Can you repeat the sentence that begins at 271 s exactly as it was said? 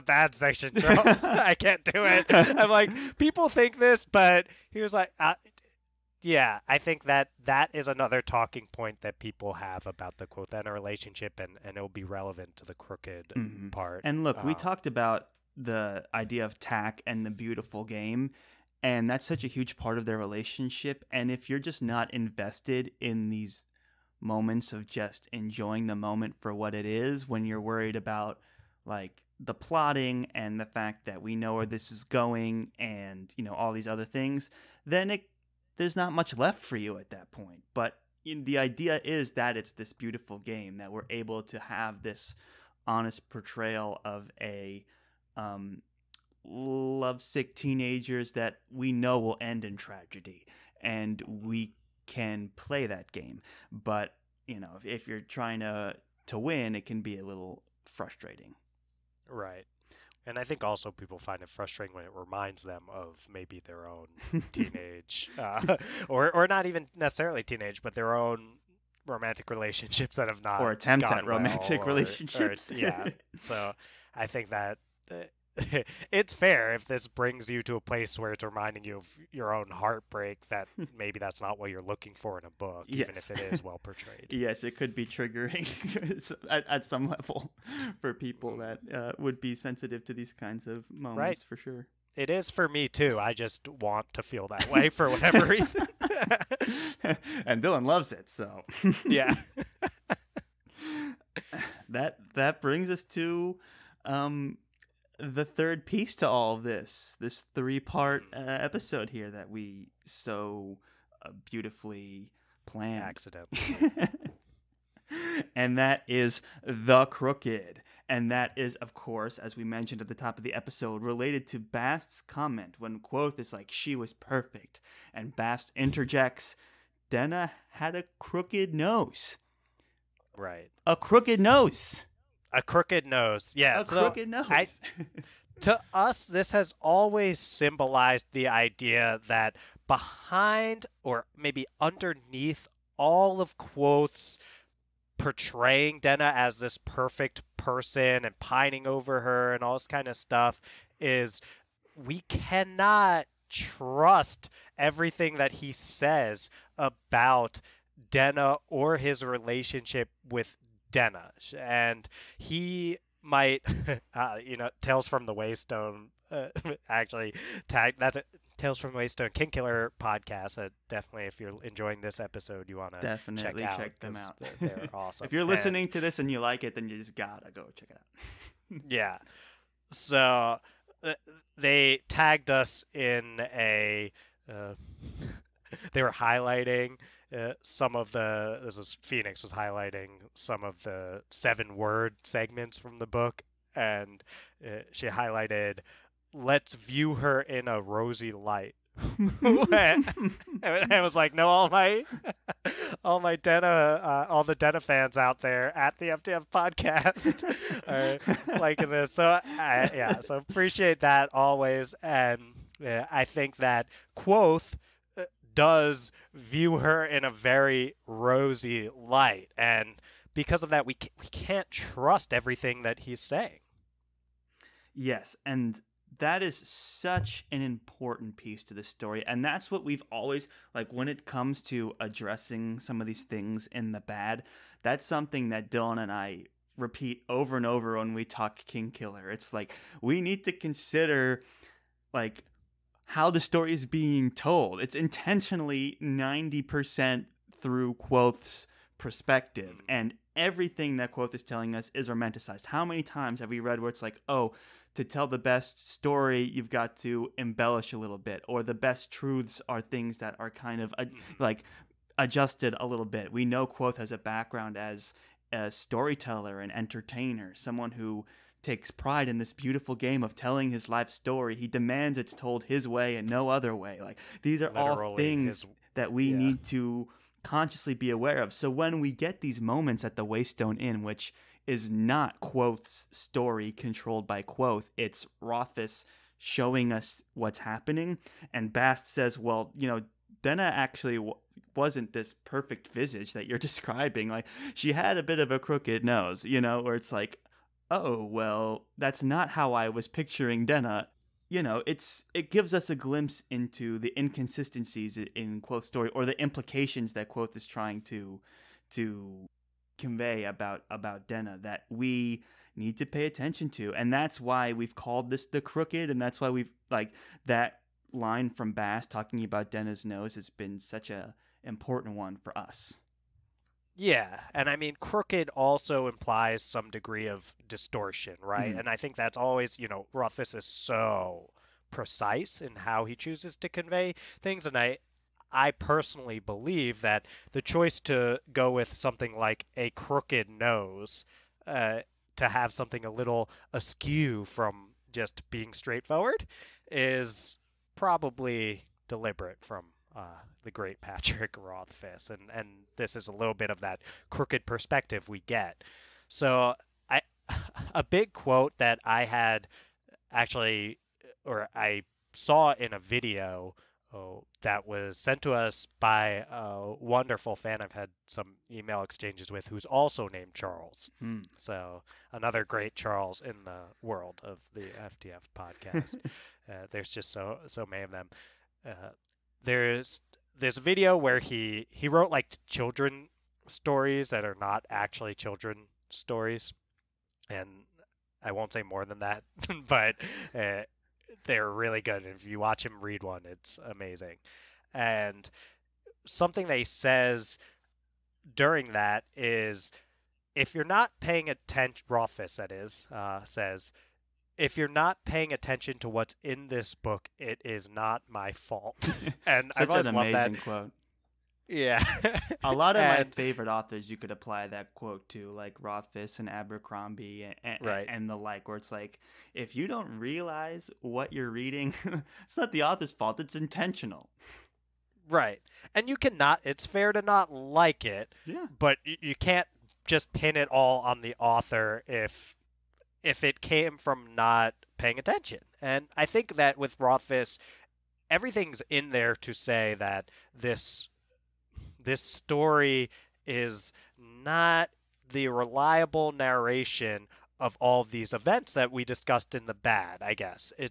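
He demands it's told his way and no other way.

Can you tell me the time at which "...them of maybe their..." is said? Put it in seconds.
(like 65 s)
62 s.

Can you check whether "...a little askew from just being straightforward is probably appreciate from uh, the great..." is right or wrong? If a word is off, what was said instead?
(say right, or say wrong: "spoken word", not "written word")
wrong: "deliberate", not "appreciate".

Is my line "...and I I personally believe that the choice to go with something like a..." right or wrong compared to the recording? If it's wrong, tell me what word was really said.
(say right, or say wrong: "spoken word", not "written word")
right.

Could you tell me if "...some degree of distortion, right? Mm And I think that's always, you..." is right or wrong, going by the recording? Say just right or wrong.
right.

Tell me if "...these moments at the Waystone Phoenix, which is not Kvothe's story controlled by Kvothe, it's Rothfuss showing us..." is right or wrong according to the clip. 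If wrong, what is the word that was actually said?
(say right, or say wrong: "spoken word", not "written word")
wrong: "Inn", not "Phoenix".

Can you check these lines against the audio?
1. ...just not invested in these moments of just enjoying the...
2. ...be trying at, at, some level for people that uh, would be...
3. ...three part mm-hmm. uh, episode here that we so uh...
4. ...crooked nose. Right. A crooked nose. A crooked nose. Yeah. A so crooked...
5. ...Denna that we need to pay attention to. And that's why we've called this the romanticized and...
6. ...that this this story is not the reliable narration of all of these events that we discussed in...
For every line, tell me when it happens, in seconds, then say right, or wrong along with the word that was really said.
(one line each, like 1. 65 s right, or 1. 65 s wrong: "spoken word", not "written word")
1. 21 s right
2. 84 s wrong: "triggering", not "trying"
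3. 107 s right
4. 128 s right
5. 311 s wrong: "crooked", not "romanticized"
6. 439 s right.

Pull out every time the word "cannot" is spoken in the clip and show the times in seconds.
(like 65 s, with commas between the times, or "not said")
152 s, 426 s.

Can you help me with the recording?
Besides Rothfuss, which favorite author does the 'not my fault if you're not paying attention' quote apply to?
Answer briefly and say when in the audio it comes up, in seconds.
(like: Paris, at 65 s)
Abercrombie, at 416 s.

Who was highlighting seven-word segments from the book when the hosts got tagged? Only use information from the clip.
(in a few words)
Phoenix.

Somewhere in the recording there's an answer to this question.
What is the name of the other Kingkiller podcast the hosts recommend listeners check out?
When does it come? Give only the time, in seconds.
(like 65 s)
164 s.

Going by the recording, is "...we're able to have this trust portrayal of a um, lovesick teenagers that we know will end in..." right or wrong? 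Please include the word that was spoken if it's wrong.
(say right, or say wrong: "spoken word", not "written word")
wrong: "honest", not "trust".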